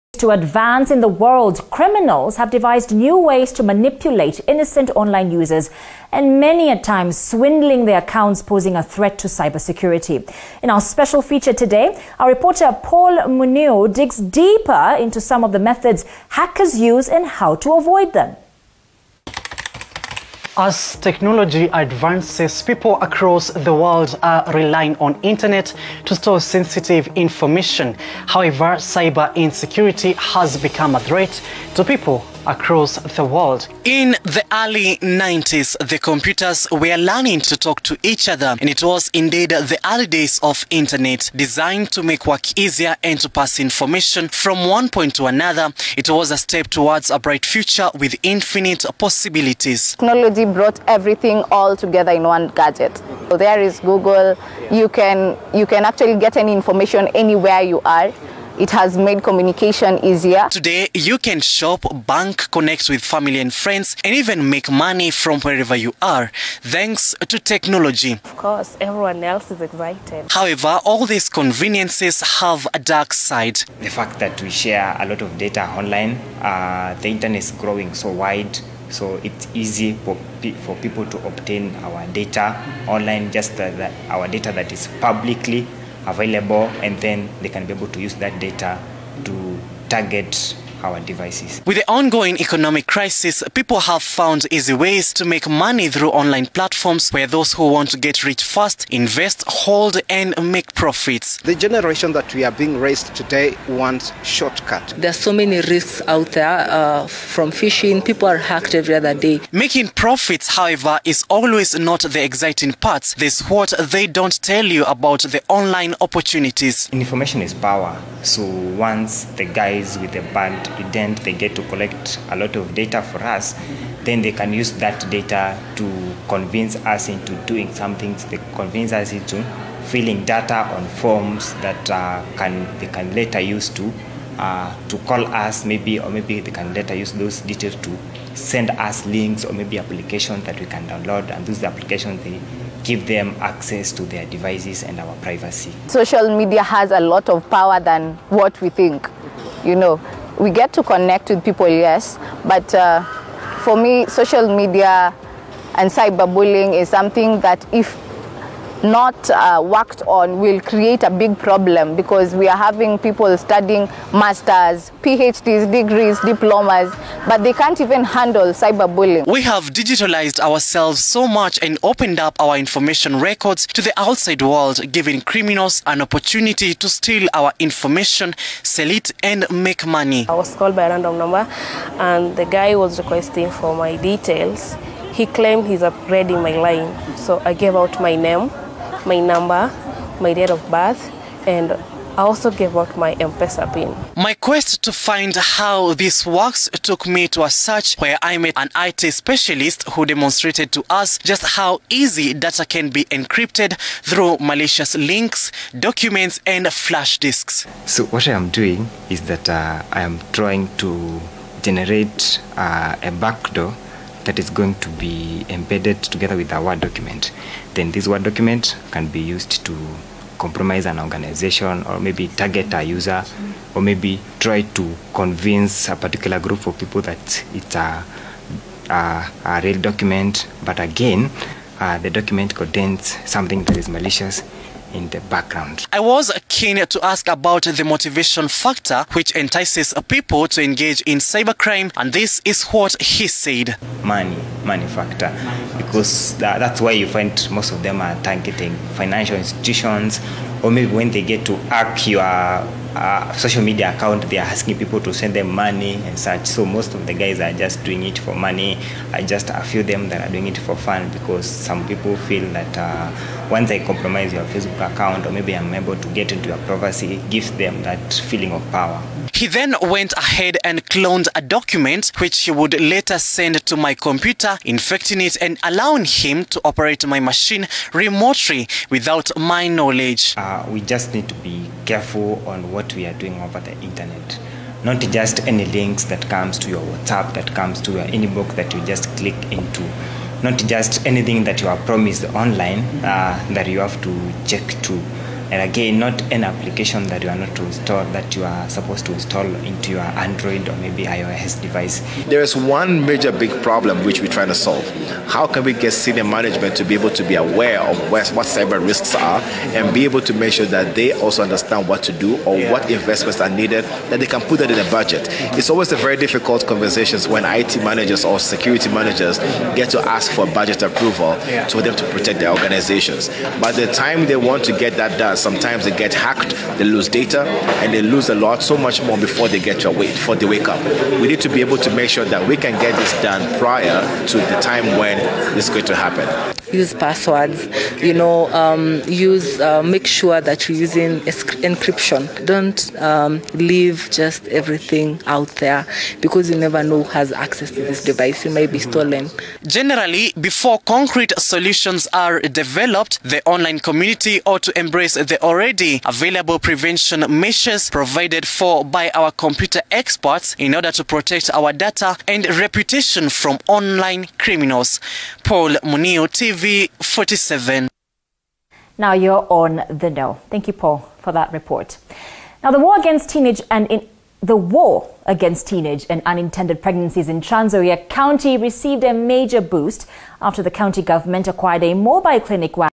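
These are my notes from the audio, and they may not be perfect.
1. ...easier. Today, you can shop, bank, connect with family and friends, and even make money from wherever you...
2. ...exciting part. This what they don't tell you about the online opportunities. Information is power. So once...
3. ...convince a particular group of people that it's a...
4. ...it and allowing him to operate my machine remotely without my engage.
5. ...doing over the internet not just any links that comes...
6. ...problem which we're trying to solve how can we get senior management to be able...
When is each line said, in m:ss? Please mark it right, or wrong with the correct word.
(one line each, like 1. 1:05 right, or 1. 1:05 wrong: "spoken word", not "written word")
1. 1:00 right
2. 1:52 right
3. 3:45 right
4. 4:35 wrong: "knowledge", not "engage"
5. 4:43 right
6. 5:03 right.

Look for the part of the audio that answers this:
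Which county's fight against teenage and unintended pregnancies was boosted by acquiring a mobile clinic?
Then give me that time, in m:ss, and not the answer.
6:17.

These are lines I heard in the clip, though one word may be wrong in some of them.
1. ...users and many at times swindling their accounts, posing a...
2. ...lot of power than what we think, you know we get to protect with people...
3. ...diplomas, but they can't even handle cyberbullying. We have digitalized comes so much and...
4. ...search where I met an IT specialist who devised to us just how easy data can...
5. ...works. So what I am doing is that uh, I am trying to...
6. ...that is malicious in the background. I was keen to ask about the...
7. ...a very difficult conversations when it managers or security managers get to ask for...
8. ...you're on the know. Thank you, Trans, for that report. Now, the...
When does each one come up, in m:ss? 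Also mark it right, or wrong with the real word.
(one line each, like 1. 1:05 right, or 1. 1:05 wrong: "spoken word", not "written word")
1. 0:05 right
2. 2:26 wrong: "connect", not "protect"
3. 2:46 wrong: "ourselves", not "comes"
4. 3:17 wrong: "demonstrated", not "devised"
5. 3:27 wrong: "disks", not "works"
6. 3:53 right
7. 5:15 right
8. 6:09 wrong: "Paul", not "Trans".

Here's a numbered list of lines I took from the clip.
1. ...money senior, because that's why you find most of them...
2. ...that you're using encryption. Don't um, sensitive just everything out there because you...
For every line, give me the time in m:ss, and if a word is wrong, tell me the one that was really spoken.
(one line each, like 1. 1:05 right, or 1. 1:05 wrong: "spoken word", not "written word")
1. 4:04 wrong: "factor", not "senior"
2. 5:40 wrong: "leave", not "sensitive".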